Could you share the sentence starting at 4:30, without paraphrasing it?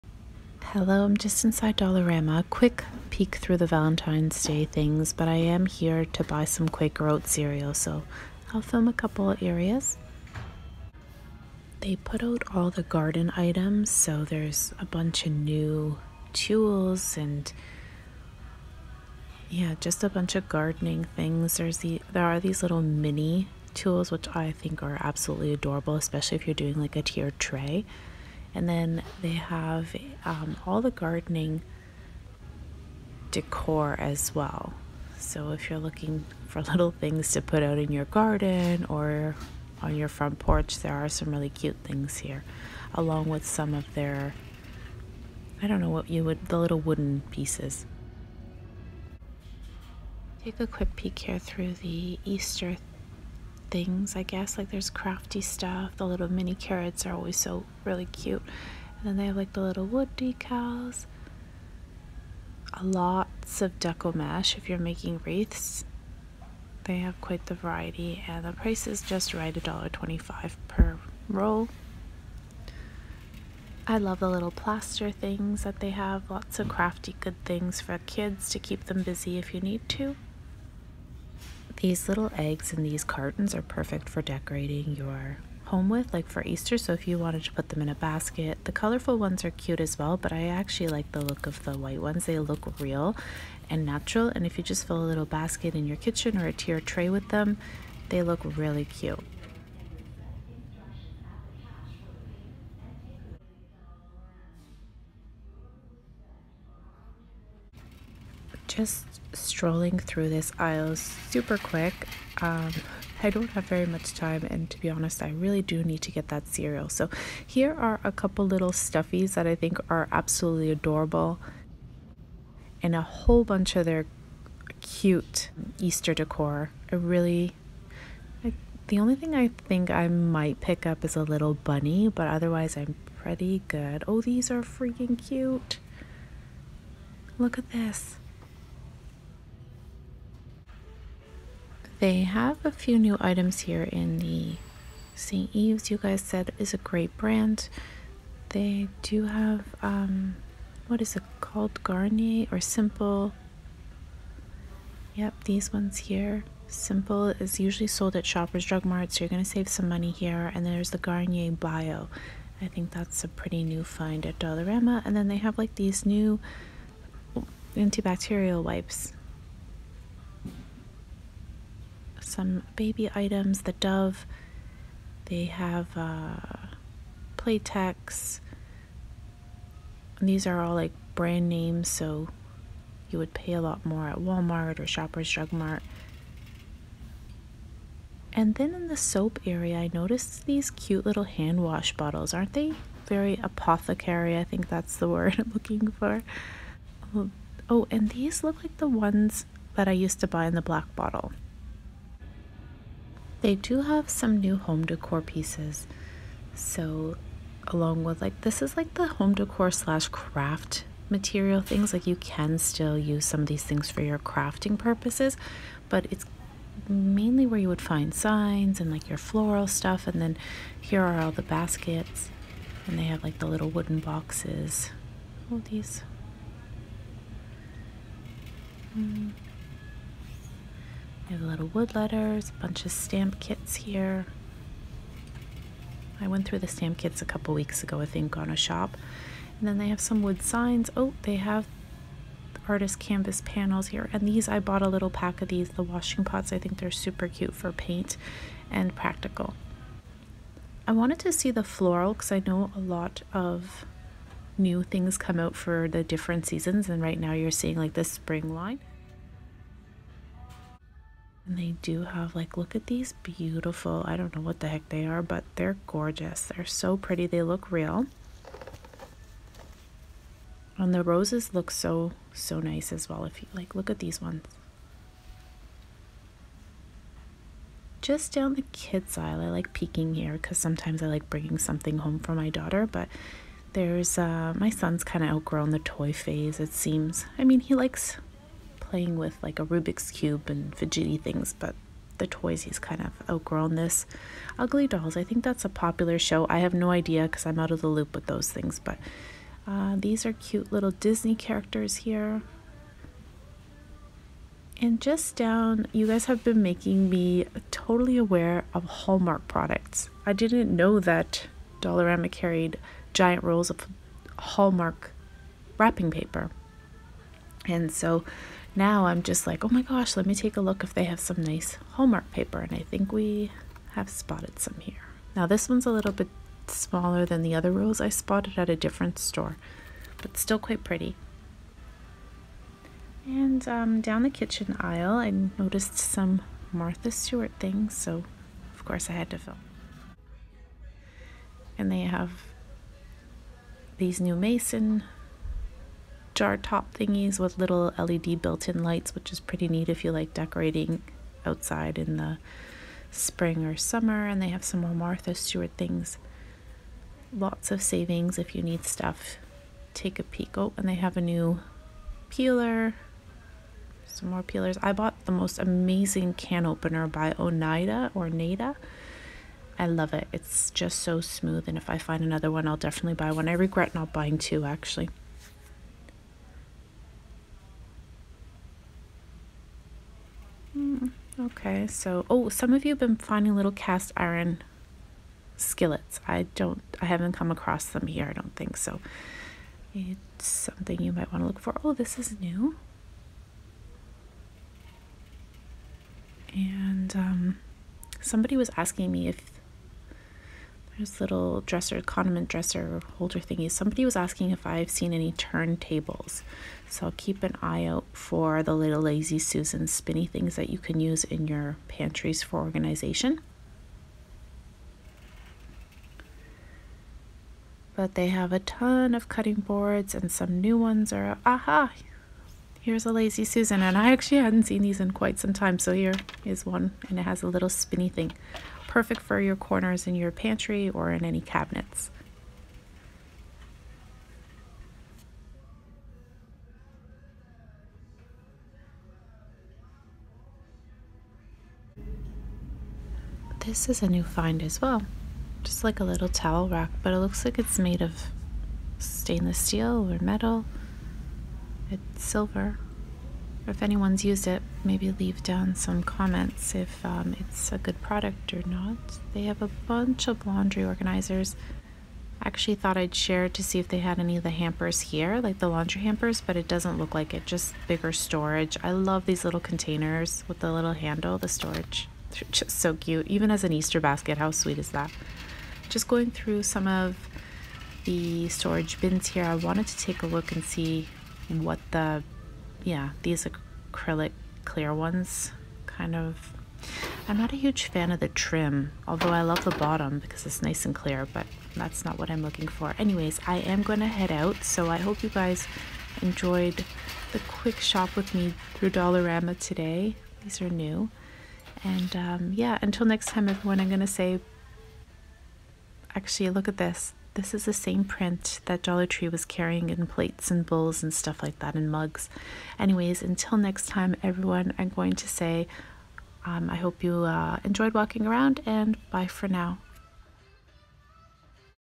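And the roses look so, so nice as well.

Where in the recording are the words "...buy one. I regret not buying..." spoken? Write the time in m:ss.
6:13.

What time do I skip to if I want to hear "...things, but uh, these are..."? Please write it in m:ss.
4:58.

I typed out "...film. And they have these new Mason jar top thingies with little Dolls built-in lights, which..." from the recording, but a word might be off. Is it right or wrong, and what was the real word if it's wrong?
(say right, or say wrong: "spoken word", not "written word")
wrong: "LED", not "Dolls".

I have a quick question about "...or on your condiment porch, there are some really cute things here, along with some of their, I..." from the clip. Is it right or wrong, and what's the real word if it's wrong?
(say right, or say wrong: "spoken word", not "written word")
wrong: "front", not "condiment".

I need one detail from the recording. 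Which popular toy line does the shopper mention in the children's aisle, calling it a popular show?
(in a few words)
Ugly Dolls.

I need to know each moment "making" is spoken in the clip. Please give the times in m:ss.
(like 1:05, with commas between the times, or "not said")
1:04, 5:06.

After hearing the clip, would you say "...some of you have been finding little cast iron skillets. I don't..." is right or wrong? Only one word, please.
right.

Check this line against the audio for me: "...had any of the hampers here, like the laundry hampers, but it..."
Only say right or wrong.
right.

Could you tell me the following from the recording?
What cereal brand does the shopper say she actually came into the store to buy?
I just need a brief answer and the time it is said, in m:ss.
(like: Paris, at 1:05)
Quaker Oat, at 0:06.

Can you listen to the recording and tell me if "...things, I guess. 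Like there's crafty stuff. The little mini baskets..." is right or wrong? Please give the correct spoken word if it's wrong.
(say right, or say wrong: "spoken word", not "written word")
wrong: "carrots", not "baskets".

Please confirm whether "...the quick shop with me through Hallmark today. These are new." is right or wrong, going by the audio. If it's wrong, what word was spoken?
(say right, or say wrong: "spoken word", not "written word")
wrong: "Dollarama", not "Hallmark".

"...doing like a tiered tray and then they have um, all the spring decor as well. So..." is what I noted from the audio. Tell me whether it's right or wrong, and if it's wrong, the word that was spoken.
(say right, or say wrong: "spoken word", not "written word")
wrong: "gardening", not "spring".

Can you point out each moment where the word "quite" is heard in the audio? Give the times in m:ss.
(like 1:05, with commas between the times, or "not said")
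1:07, 5:30, 7:05.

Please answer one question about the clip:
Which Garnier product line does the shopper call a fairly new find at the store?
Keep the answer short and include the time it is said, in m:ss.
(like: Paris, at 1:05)
Garnier Bio, at 2:40.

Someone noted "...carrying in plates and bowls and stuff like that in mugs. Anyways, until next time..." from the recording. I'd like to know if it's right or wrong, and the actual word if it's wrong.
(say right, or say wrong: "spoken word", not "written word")
right.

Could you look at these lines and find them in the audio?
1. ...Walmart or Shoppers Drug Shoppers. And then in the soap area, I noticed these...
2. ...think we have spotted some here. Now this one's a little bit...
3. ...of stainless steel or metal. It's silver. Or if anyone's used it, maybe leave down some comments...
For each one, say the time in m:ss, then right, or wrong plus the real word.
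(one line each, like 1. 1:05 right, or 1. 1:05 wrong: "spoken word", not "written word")
1. 3:04 wrong: "Mart", not "Shoppers"
2. 5:22 right
3. 7:28 right.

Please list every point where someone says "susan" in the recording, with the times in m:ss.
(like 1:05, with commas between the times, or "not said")
6:49, 7:03.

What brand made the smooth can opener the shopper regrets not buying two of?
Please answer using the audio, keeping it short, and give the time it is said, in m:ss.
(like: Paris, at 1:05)
Oneida, at 6:07.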